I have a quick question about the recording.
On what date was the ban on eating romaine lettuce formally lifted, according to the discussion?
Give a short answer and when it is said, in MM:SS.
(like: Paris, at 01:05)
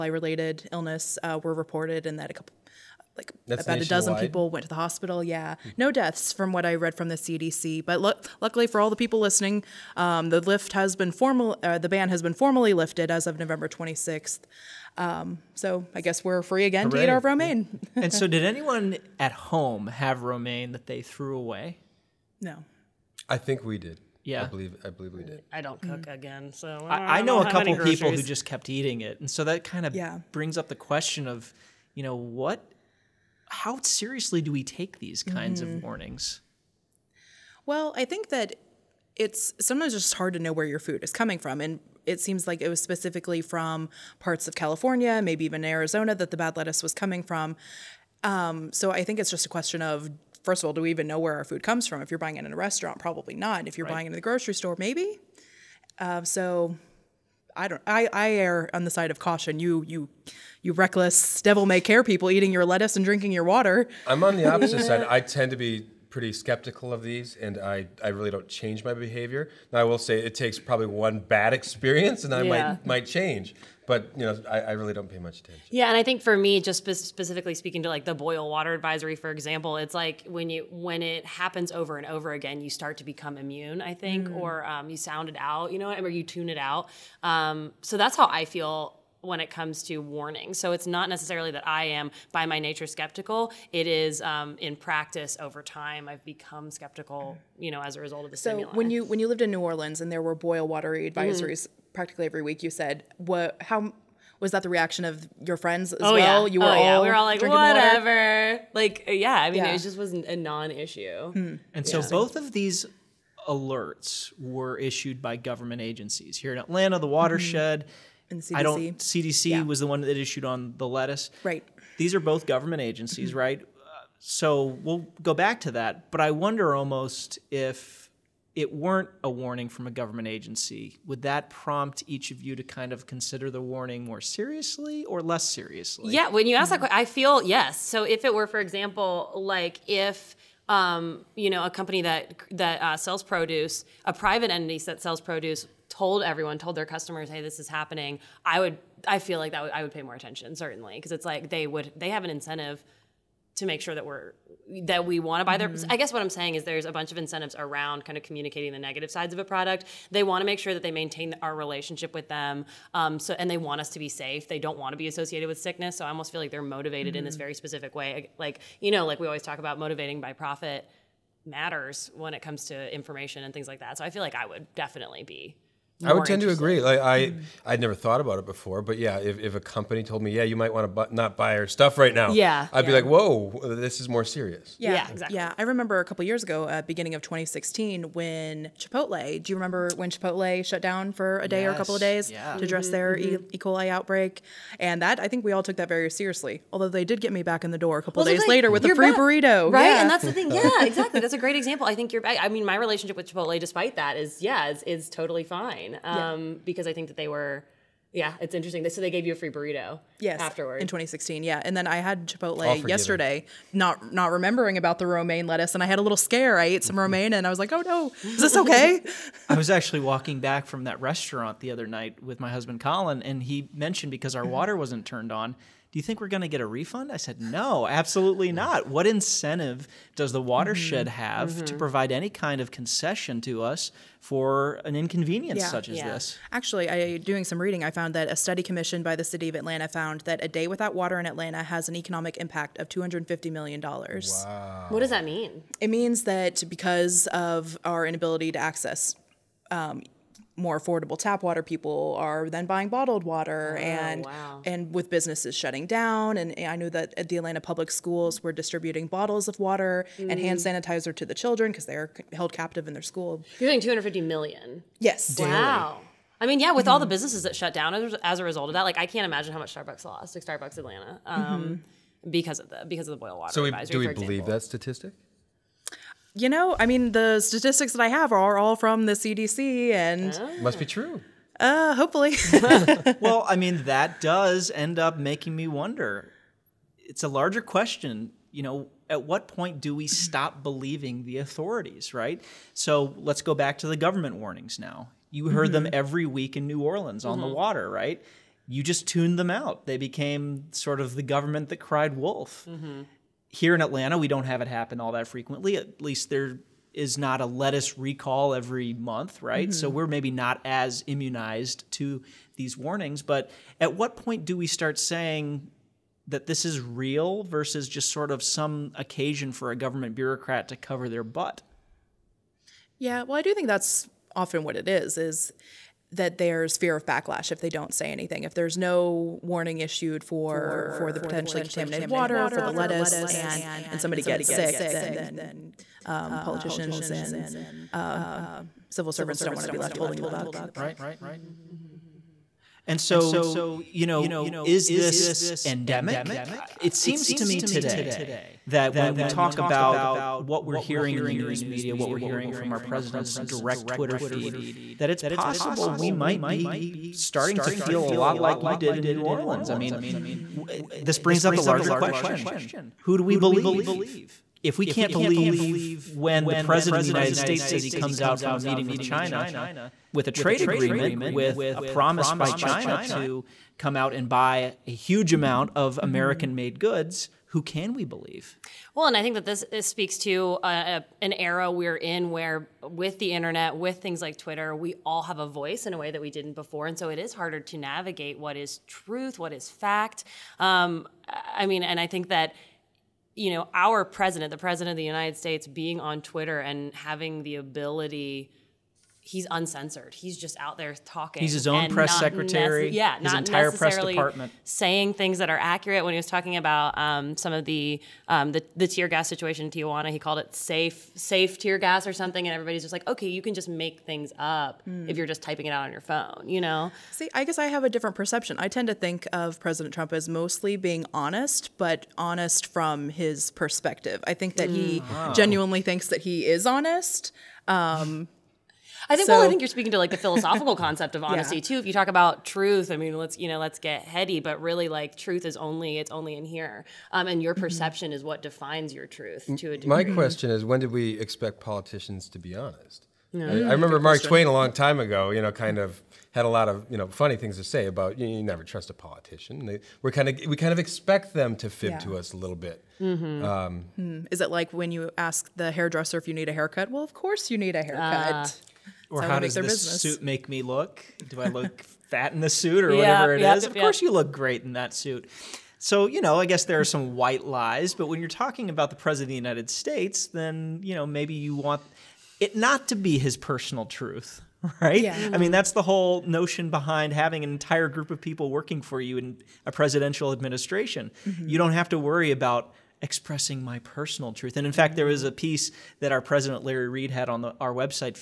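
November 26th, at 00:13.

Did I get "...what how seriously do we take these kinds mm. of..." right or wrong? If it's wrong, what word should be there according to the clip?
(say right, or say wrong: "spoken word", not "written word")
right.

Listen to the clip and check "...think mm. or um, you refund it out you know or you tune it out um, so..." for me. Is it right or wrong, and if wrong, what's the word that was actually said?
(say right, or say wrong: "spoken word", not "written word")
wrong: "sound", not "refund".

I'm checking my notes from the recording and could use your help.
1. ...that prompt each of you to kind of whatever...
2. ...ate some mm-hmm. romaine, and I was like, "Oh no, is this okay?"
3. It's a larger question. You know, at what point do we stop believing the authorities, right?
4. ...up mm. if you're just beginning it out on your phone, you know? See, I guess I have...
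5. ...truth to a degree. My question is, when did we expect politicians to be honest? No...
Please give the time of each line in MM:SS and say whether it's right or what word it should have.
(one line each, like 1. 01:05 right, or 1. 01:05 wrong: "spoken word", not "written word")
1. 02:11 wrong: "consider", not "whatever"
2. 03:36 right
3. 04:46 right
4. 06:54 wrong: "typing", not "beginning"
5. 07:19 right.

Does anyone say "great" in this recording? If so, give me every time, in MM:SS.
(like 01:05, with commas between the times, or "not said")
03:21, 07:44.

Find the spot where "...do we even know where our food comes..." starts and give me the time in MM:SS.
00:50.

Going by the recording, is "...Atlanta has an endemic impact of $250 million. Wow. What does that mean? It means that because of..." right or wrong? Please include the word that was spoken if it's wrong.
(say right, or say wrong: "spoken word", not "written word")
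wrong: "economic", not "endemic".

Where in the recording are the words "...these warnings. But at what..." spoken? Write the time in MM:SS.
05:12.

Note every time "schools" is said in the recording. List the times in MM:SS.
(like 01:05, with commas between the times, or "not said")
04:17, 04:23.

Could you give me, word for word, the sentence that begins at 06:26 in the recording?
And so it is harder to navigate what is truth, what is fact.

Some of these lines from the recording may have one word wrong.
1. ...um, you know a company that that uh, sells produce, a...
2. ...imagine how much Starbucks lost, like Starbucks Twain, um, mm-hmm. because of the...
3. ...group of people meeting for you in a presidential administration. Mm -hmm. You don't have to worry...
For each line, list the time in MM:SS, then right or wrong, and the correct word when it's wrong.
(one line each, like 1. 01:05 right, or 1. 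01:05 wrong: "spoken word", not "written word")
1. 02:20 right
2. 04:29 wrong: "Atlanta", not "Twain"
3. 07:57 wrong: "working", not "meeting".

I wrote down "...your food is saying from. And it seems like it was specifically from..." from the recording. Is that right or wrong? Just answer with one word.
wrong.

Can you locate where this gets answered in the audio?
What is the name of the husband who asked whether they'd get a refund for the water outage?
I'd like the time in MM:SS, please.
03:42.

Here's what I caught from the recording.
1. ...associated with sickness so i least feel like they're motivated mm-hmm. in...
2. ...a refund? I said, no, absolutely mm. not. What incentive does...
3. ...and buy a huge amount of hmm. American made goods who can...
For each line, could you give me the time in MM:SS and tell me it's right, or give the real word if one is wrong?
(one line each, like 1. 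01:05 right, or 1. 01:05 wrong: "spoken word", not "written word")
1. 02:45 wrong: "almost", not "least"
2. 03:46 right
3. 06:14 right.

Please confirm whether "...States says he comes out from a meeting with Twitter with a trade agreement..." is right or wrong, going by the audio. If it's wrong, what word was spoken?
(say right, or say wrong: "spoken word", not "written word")
wrong: "China", not "Twitter".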